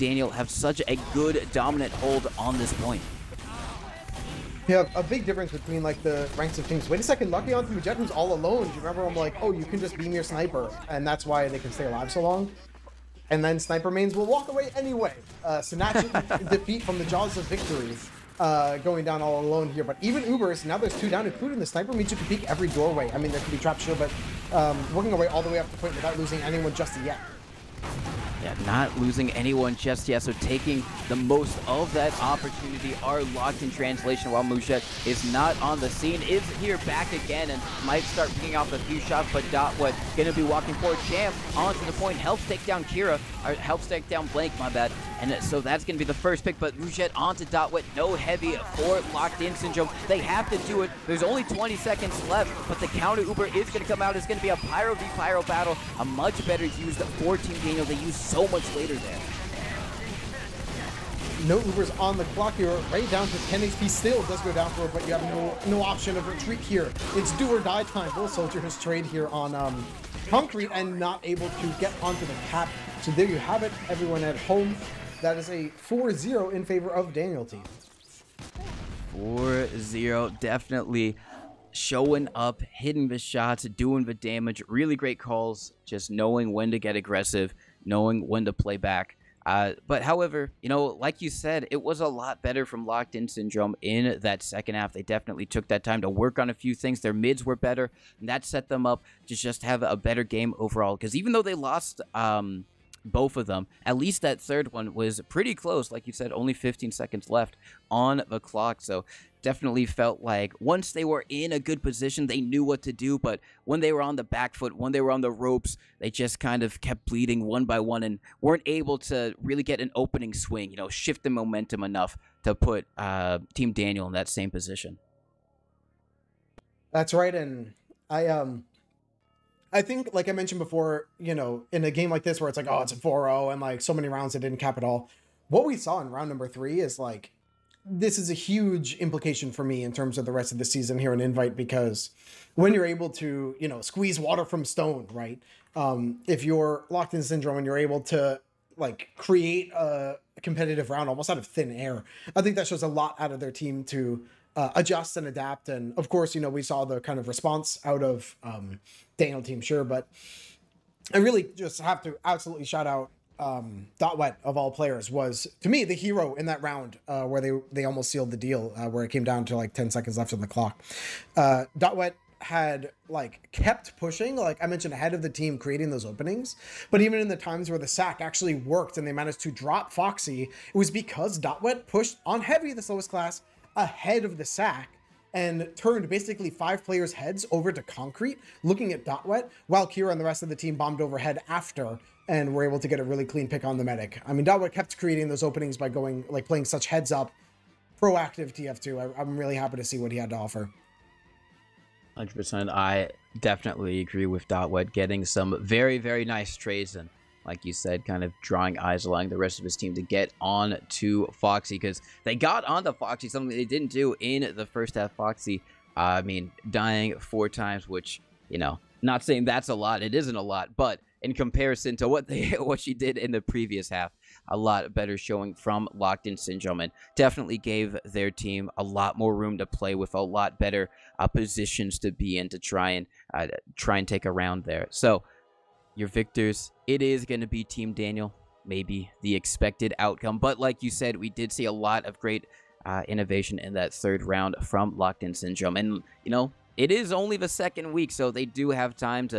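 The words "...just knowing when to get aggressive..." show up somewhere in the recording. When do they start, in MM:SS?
01:25.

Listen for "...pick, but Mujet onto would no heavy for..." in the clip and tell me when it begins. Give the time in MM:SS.
00:46.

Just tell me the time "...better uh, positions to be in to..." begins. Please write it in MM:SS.
03:50.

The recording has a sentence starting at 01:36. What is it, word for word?
Their mids were better, and that set them up to just have a better game overall.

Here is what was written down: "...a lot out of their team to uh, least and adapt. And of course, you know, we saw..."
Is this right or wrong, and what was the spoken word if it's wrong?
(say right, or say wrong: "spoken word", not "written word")
wrong: "adjust", not "least".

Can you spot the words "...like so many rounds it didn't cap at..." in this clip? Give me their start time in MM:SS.
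02:13.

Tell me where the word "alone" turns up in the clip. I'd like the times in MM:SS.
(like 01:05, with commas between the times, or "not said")
00:08, 00:19.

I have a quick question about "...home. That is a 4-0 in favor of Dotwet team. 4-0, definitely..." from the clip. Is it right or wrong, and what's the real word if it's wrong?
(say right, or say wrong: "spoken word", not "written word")
wrong: "Daniel", not "Dotwet".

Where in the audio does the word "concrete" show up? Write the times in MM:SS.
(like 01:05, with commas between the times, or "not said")
01:10, 03:07.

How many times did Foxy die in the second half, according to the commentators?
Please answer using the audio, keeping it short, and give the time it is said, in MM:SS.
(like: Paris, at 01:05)
4, at 03:36.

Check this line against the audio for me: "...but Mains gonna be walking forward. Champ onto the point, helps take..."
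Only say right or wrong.
wrong.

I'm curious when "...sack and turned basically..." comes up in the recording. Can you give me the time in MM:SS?
03:04.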